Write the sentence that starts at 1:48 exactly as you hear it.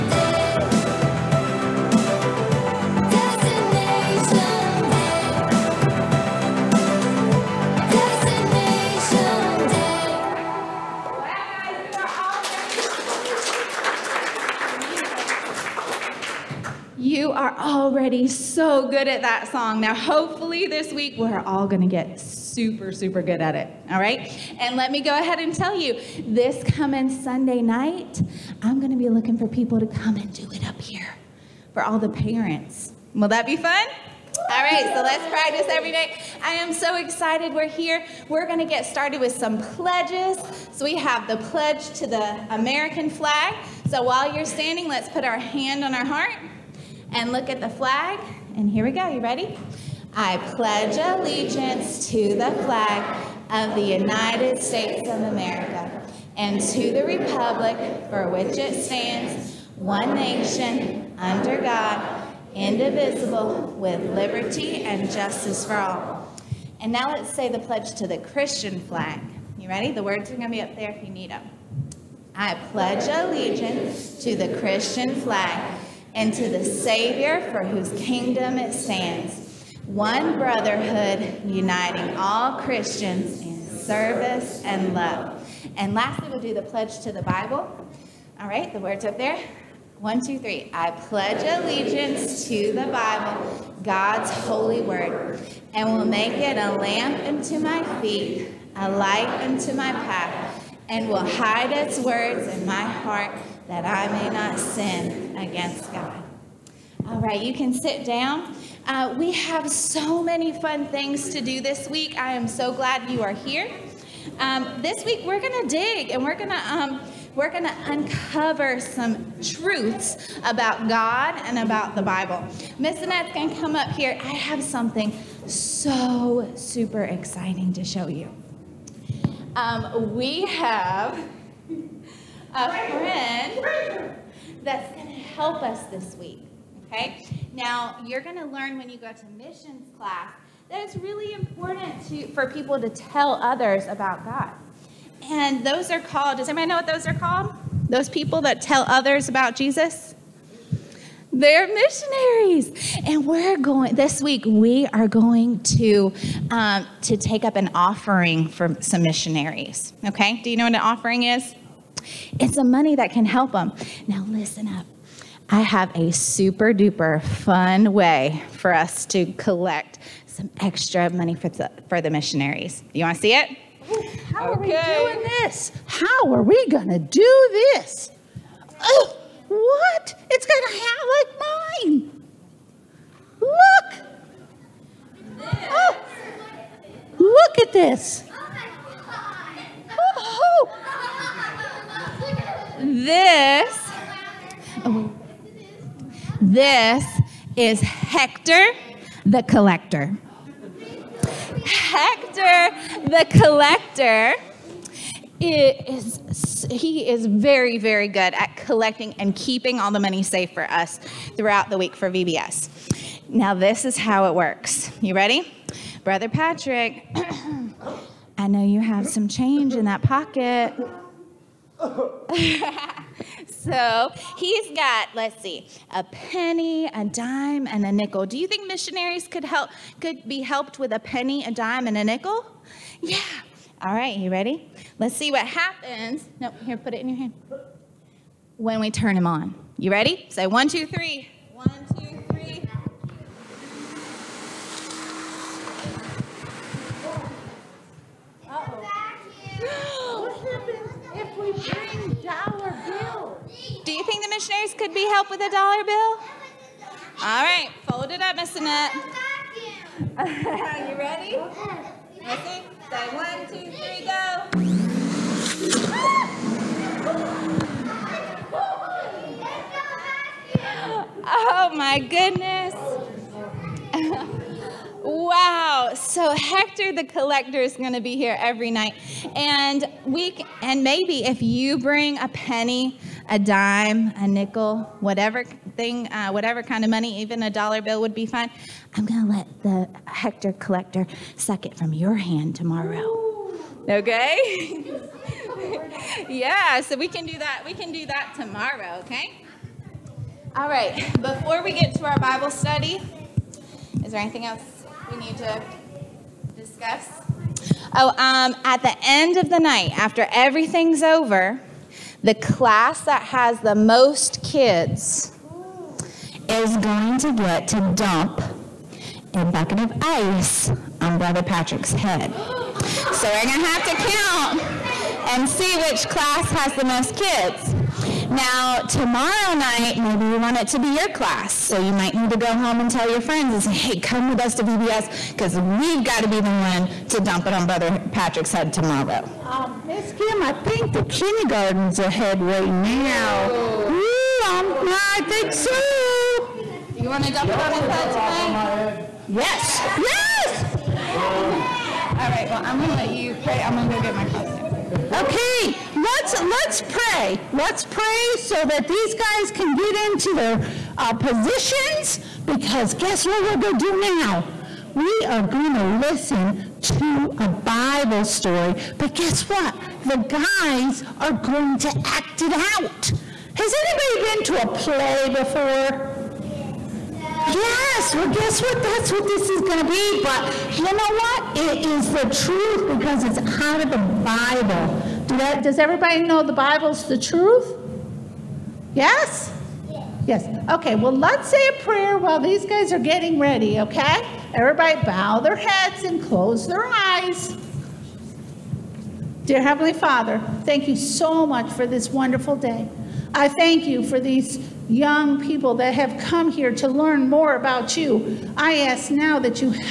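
Uh, we have so many fun things to do this week.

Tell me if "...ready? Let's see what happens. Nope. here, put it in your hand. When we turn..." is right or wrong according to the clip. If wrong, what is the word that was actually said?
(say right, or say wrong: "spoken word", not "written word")
right.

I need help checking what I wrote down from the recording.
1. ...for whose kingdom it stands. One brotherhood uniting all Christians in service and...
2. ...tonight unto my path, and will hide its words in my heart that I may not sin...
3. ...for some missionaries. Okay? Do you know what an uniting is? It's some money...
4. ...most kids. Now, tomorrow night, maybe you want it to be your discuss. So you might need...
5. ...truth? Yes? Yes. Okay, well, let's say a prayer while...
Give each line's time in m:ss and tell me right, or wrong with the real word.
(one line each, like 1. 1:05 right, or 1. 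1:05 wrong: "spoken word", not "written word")
1. 1:17 right
2. 1:38 wrong: "light", not "tonight"
3. 2:38 wrong: "offering", not "uniting"
4. 5:26 wrong: "class", not "discuss"
5. 6:27 right.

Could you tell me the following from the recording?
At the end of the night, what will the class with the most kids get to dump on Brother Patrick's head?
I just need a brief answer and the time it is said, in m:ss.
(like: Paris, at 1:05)
A bucket of ice, at 5:19.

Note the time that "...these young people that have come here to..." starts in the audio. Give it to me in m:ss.
6:44.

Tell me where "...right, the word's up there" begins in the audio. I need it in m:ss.
1:28.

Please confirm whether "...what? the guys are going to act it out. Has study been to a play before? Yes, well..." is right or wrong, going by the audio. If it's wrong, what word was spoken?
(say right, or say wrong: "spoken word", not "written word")
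wrong: "anybody", not "study".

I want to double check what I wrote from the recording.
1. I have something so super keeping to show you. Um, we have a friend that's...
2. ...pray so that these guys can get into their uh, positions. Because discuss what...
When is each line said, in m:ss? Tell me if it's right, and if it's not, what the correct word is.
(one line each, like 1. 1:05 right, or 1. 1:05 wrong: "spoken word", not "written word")
1. 2:04 wrong: "exciting", not "keeping"
2. 5:57 wrong: "guess", not "discuss".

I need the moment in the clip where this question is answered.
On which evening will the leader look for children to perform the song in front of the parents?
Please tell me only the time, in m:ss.
0:27.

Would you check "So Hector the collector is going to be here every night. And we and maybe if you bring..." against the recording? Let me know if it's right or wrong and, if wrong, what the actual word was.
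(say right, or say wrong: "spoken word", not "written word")
right.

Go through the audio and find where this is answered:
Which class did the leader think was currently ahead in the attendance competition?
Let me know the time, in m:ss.
5:41.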